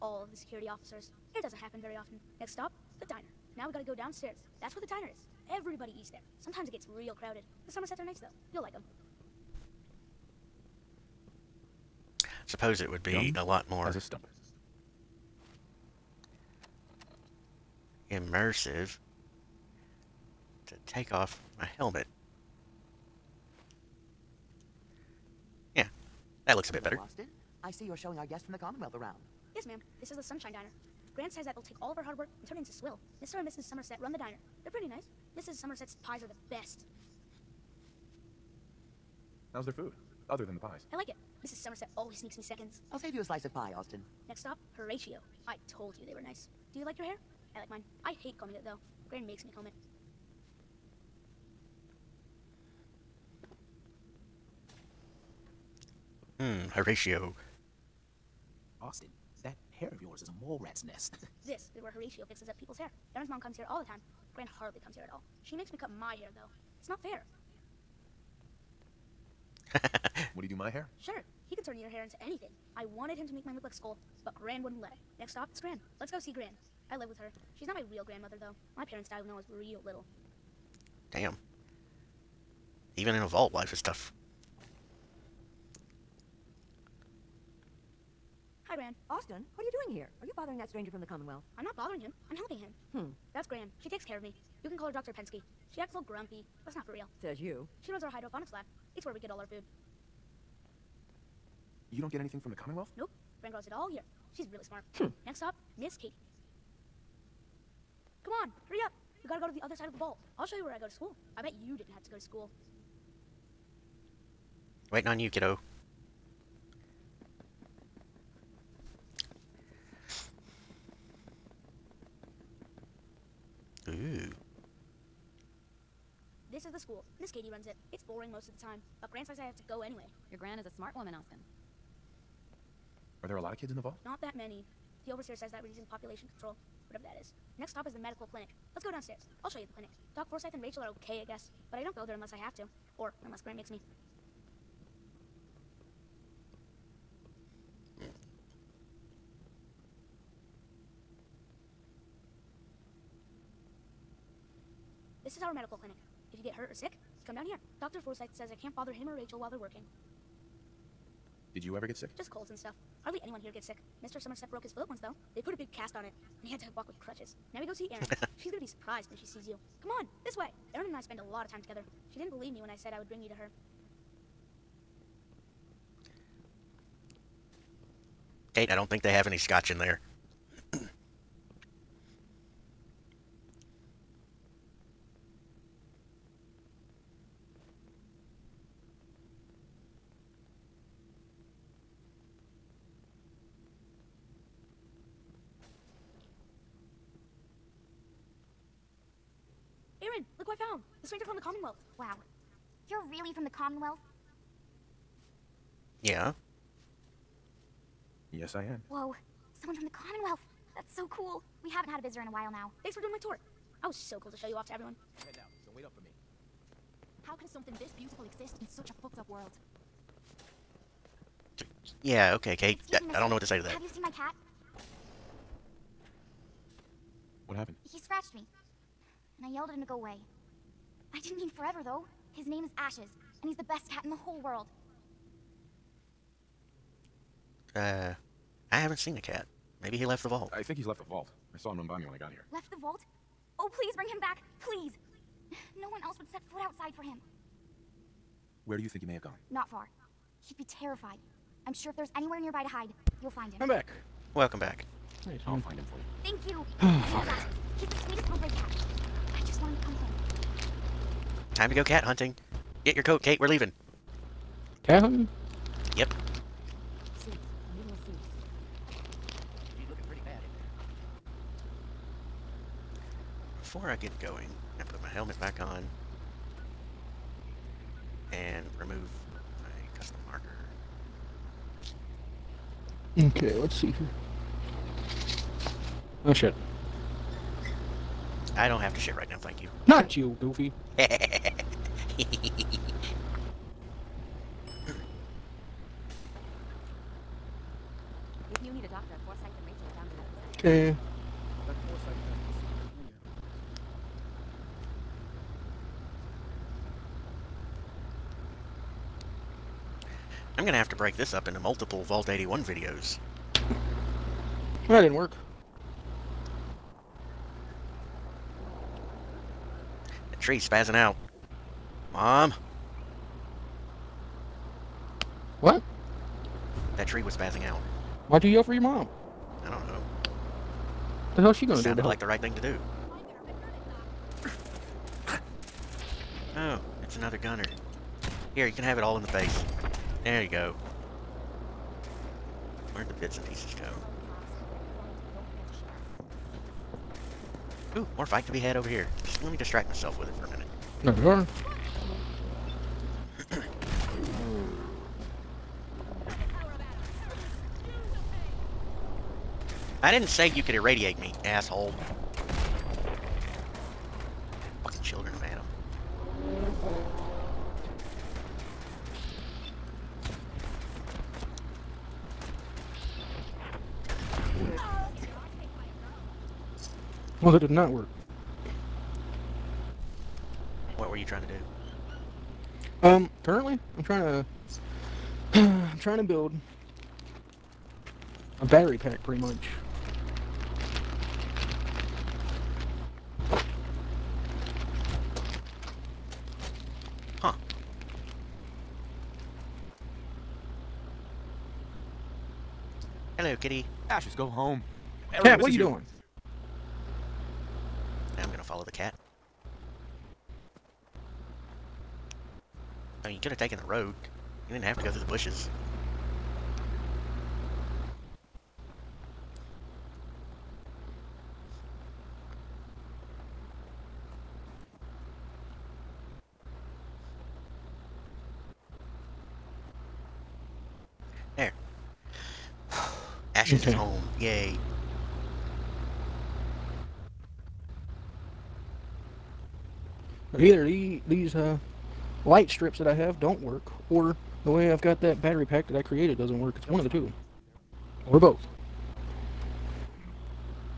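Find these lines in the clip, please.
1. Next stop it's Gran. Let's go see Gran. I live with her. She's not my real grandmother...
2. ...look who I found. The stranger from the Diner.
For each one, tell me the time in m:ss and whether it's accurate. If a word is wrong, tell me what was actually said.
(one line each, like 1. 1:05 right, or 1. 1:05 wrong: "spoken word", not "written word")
1. 1:15 right
2. 3:20 wrong: "Commonwealth", not "Diner".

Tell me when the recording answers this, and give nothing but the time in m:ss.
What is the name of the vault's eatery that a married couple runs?
0:30.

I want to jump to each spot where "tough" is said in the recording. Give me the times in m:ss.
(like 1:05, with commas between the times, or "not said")
1:23.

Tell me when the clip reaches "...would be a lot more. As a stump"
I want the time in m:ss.
0:12.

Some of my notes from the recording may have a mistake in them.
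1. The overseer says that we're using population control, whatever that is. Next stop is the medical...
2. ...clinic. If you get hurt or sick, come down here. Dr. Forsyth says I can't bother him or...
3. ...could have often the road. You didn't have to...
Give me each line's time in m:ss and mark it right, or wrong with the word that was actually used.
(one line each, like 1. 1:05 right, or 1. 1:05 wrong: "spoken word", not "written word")
1. 2:15 right
2. 2:35 right
3. 6:53 wrong: "taken", not "often".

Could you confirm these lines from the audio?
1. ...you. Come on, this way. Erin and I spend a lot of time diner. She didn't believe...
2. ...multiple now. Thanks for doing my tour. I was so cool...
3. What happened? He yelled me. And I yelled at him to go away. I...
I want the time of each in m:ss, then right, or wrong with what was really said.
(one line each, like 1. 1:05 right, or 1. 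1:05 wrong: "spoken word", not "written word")
1. 2:49 wrong: "together", not "diner"
2. 3:32 wrong: "while", not "multiple"
3. 3:47 wrong: "scratched", not "yelled".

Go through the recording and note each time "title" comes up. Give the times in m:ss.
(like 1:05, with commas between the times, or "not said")
not said.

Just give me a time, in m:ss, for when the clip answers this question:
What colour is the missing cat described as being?
4:18.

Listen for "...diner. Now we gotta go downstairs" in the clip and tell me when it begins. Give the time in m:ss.
0:03.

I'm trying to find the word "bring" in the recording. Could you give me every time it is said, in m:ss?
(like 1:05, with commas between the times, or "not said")
2:53, 4:03.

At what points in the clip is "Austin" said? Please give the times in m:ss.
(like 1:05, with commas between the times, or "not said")
0:26, 0:43, 0:58, 1:29, 2:11.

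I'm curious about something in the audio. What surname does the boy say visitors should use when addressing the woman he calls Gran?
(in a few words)
Penske.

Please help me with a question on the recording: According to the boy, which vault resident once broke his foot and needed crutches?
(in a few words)
Mr. Somerset.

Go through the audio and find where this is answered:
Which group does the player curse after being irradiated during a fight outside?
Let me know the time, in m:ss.
6:05.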